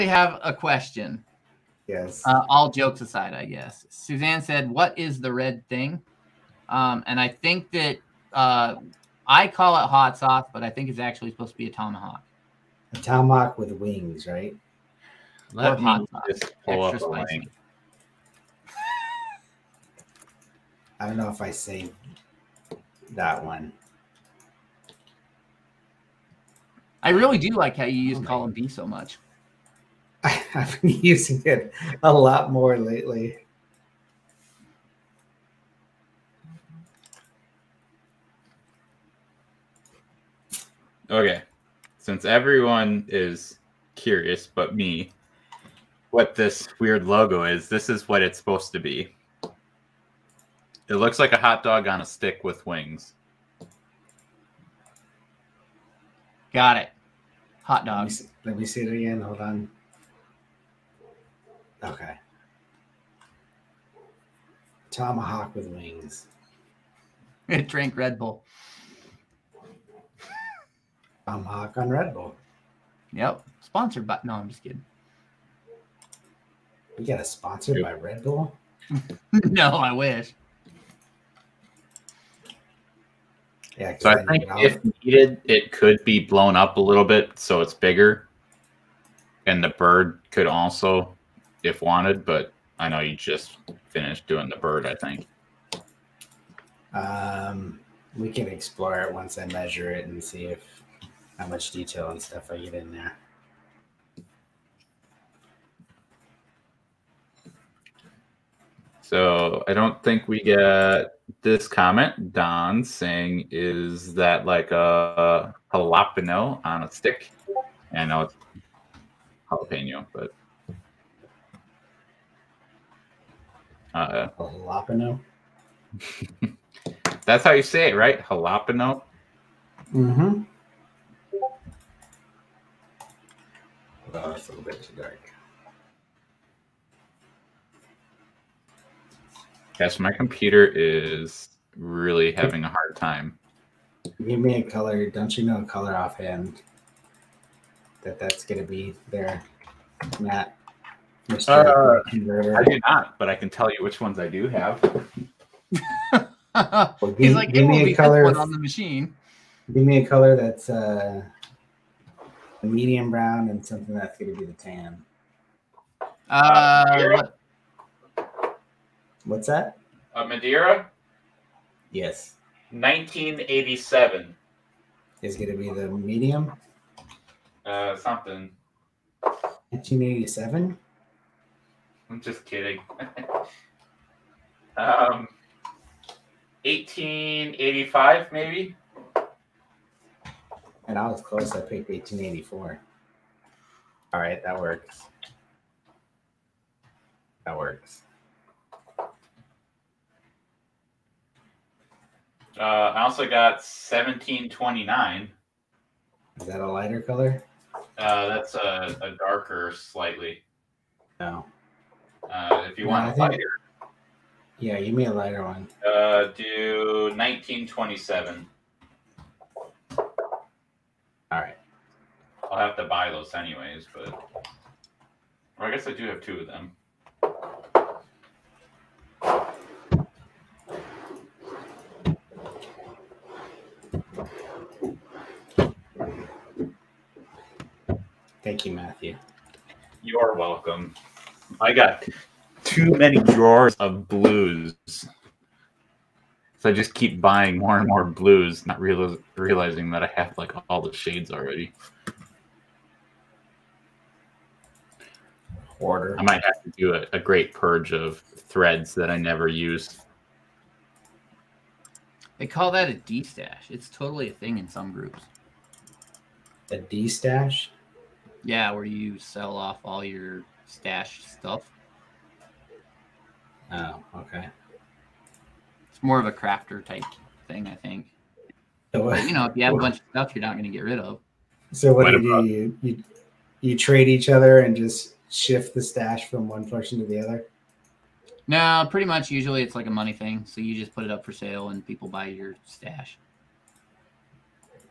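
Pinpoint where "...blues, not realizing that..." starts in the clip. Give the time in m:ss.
4:08.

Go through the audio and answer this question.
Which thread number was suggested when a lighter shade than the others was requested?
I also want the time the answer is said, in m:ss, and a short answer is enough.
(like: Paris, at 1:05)
1927, at 3:37.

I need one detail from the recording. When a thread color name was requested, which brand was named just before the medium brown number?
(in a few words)
Madeira.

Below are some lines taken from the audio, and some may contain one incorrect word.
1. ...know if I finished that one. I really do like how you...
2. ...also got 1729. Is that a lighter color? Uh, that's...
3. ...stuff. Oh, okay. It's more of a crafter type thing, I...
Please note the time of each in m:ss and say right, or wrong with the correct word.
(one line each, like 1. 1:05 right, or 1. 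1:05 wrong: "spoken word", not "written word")
1. 0:21 wrong: "saved", not "finished"
2. 3:23 right
3. 4:31 right.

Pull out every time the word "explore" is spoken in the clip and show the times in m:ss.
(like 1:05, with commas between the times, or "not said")
1:38.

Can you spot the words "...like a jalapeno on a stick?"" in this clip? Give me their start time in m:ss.
1:54.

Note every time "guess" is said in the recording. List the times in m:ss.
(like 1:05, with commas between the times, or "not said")
0:03, 3:45.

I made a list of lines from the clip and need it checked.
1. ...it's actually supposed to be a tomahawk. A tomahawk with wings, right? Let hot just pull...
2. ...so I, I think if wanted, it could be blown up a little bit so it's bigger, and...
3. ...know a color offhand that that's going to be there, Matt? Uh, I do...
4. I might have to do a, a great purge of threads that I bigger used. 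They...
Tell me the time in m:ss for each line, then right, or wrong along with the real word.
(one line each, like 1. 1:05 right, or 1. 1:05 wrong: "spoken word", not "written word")
1. 0:10 right
2. 1:23 wrong: "needed", not "wanted"
3. 2:25 right
4. 4:16 wrong: "never", not "bigger".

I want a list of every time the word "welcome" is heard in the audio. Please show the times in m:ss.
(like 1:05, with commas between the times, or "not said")
4:00.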